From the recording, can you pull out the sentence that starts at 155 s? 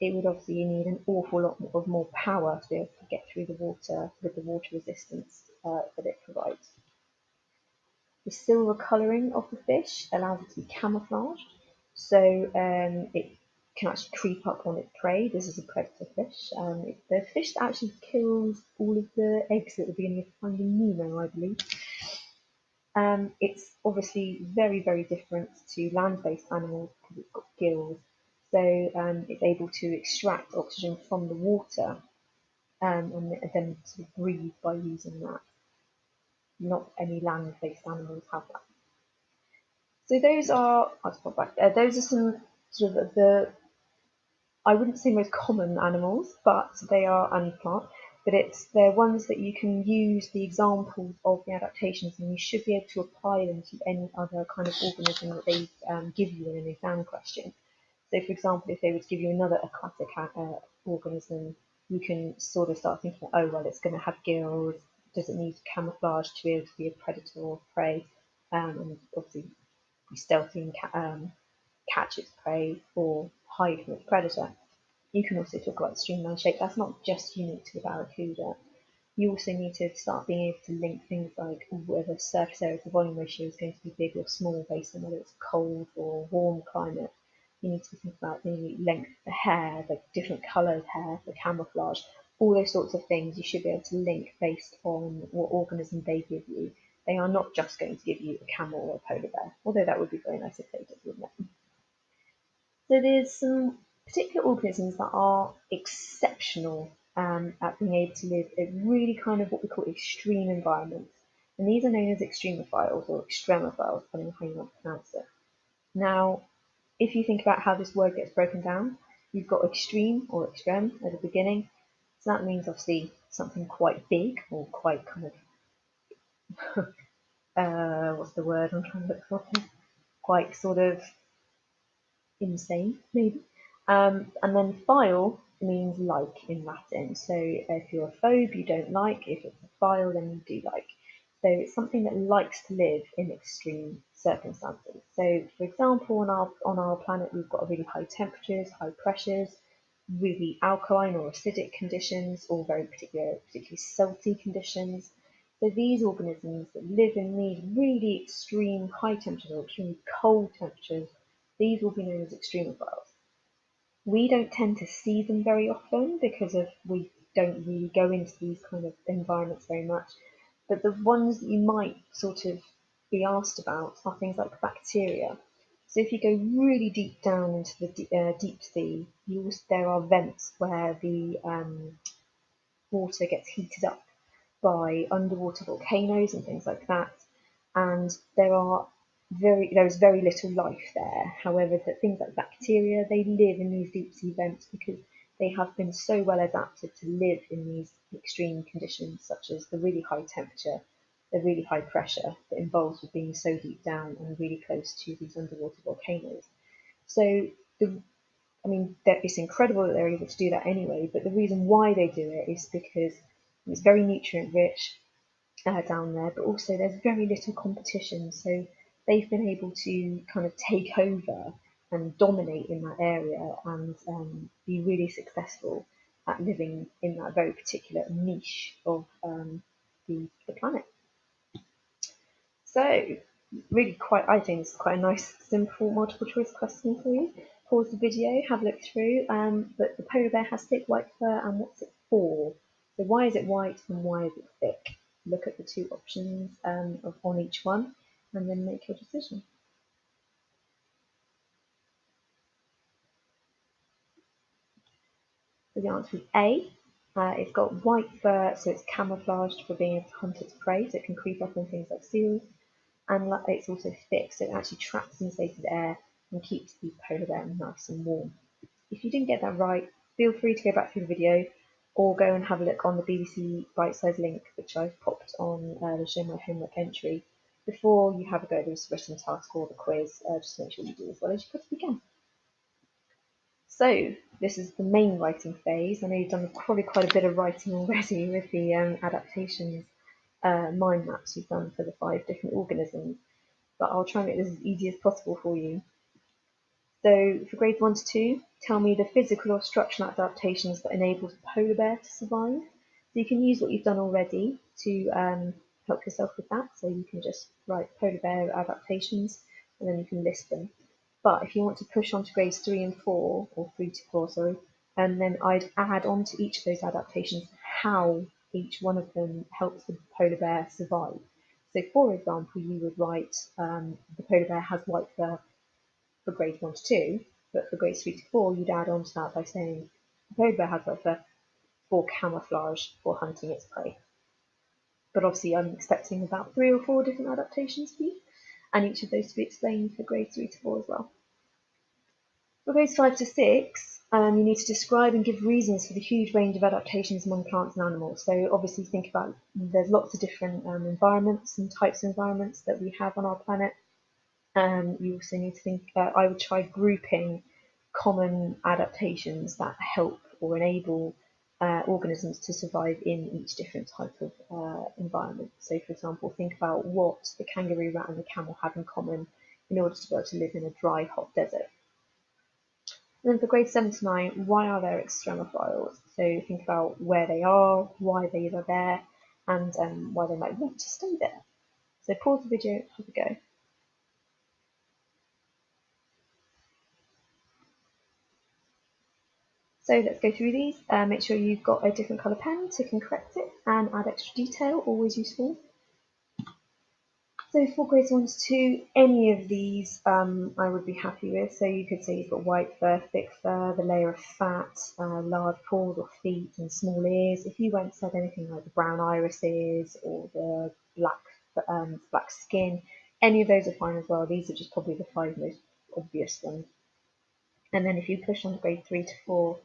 So these organisms that live in these really extreme high temperatures or extremely cold temperatures, these will be known as extremophiles.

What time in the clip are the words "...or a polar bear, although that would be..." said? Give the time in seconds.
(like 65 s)
98 s.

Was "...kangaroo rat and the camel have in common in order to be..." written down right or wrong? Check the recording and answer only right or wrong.
right.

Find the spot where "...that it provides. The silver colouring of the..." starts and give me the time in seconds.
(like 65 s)
5 s.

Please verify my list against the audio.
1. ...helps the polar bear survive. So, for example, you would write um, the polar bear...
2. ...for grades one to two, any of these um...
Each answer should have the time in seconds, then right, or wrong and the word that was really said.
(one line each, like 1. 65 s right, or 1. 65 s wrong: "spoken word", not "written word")
1. 319 s right
2. 397 s right.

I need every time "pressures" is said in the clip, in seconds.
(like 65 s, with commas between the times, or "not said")
149 s, 201 s.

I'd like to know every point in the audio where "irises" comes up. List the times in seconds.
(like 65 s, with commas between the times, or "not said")
409 s.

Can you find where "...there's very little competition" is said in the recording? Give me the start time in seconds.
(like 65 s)
216 s.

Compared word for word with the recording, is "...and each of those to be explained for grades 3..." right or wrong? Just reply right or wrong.
right.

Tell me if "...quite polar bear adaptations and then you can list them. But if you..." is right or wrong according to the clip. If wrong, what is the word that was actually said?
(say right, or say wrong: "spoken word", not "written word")
wrong: "write", not "quite".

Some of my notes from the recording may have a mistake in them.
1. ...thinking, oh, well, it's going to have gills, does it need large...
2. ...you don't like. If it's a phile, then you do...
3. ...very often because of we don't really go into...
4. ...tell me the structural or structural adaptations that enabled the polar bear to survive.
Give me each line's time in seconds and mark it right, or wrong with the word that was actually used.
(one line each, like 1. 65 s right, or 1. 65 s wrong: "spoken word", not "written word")
1. 63 s wrong: "camouflage", not "large"
2. 138 s right
3. 165 s right
4. 298 s wrong: "physical", not "structural".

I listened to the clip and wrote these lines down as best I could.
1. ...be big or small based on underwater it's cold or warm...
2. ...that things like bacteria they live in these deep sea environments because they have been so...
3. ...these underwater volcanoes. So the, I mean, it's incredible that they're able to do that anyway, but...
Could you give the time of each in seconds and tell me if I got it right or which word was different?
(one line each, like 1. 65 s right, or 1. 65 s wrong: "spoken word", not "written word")
1. 83 s wrong: "whether", not "underwater"
2. 191 s wrong: "vents", not "environments"
3. 205 s right.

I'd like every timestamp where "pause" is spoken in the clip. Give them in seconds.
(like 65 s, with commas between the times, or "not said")
237 s, 382 s.